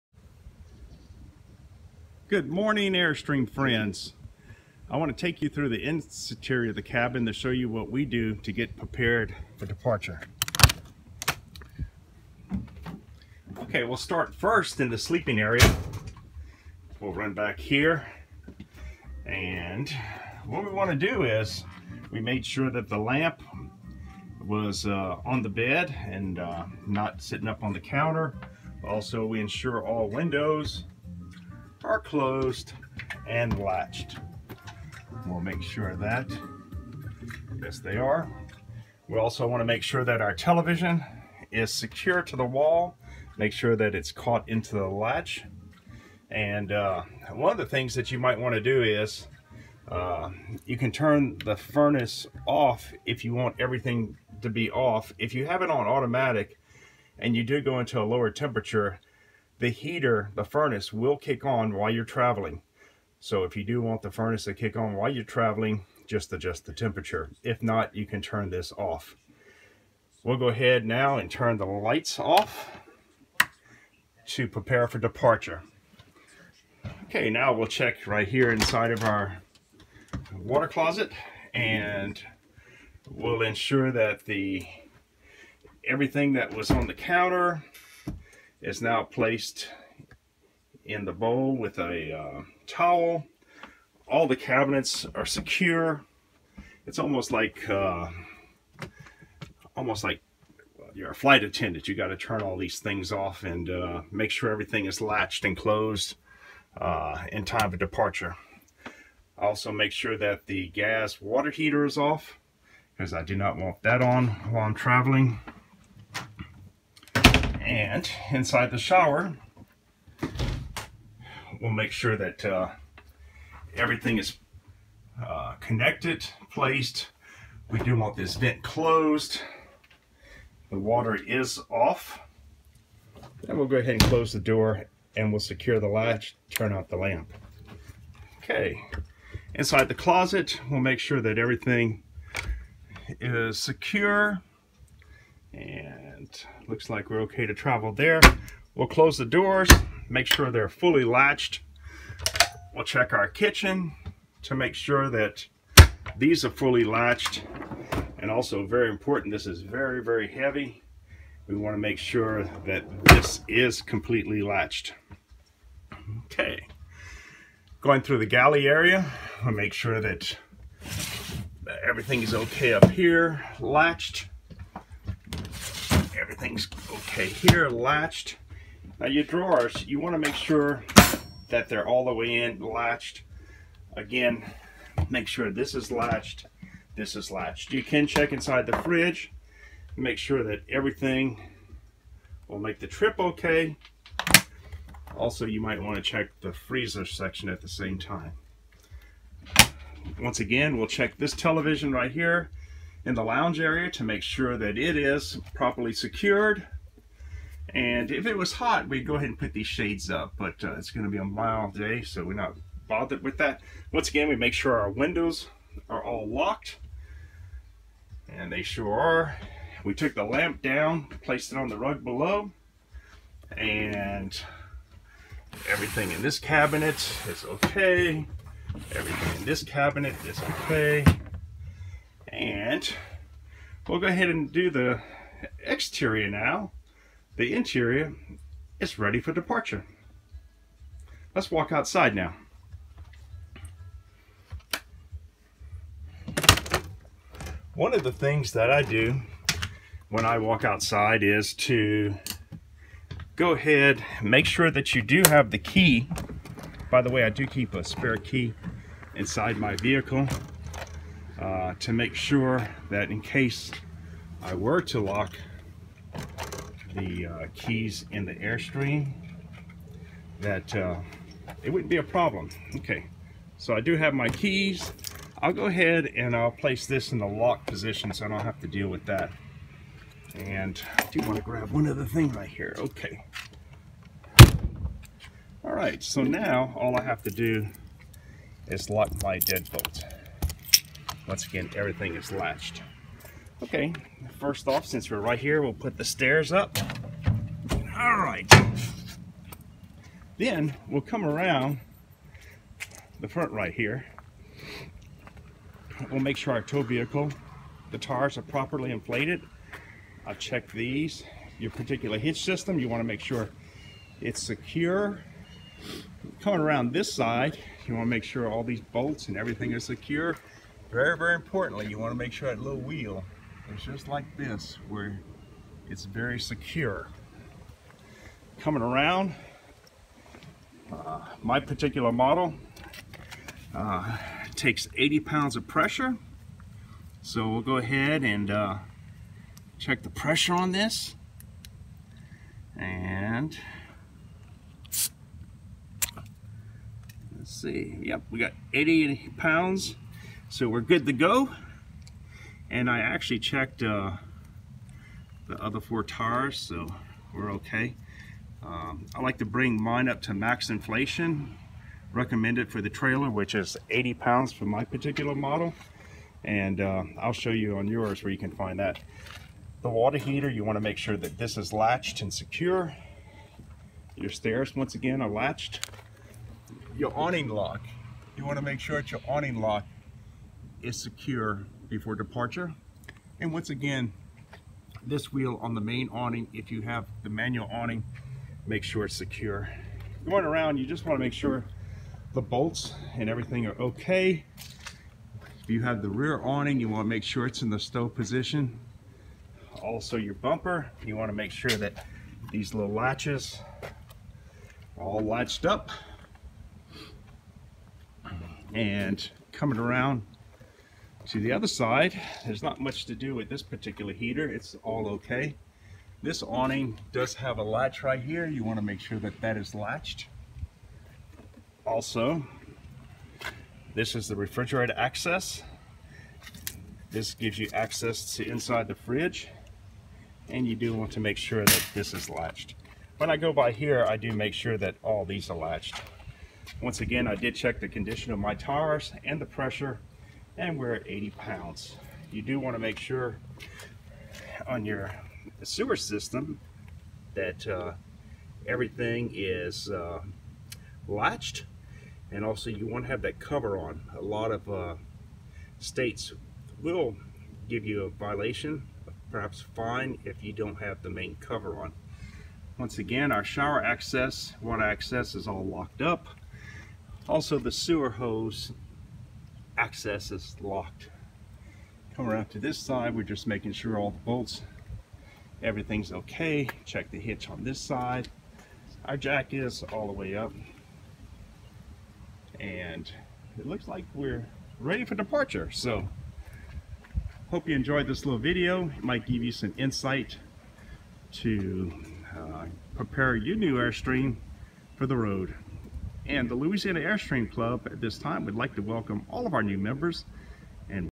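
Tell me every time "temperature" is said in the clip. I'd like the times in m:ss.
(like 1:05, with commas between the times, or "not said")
0:58, 1:06.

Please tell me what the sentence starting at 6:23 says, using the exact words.
And once again, this wheel on the main awning, if you have the manual awning, make sure it's secure.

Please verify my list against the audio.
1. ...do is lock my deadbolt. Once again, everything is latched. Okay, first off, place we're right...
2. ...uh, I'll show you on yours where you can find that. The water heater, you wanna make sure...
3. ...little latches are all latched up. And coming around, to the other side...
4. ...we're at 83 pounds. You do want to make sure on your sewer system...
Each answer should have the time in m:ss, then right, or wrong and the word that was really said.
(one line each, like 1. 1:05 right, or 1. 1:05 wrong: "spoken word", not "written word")
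1. 4:47 wrong: "since", not "place"
2. 6:06 right
3. 6:42 right
4. 7:20 wrong: "80", not "83".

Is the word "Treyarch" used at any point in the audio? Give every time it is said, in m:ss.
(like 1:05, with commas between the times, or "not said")
not said.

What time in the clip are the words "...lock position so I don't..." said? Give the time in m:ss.
4:37.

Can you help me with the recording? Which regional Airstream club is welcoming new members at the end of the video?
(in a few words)
Louisiana Airstream Club.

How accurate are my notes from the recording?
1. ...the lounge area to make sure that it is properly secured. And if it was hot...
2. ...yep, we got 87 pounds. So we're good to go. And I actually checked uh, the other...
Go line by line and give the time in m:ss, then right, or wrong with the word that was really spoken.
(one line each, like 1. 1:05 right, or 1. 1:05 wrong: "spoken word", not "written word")
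1. 3:23 right
2. 5:48 wrong: "80", not "87".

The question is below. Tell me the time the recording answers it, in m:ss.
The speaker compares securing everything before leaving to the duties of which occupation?
1:41.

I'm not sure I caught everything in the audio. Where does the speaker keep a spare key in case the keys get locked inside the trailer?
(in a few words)
Inside my vehicle.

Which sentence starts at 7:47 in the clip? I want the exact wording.
Also the sewer hose access is locked.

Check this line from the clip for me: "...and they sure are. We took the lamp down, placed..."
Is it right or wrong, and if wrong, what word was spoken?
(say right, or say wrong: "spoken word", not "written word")
right.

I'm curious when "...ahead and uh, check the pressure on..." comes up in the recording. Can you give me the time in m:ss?
5:37.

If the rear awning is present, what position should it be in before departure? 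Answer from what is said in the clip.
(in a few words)
Stow position.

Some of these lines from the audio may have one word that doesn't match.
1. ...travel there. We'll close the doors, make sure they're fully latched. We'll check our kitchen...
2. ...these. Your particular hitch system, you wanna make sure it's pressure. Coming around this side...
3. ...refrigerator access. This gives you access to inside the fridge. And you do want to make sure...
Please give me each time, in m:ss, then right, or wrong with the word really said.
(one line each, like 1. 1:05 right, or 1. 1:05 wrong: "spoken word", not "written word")
1. 2:27 right
2. 5:10 wrong: "secure", not "pressure"
3. 7:04 right.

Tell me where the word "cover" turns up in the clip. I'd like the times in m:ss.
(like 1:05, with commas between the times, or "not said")
7:33, 7:41.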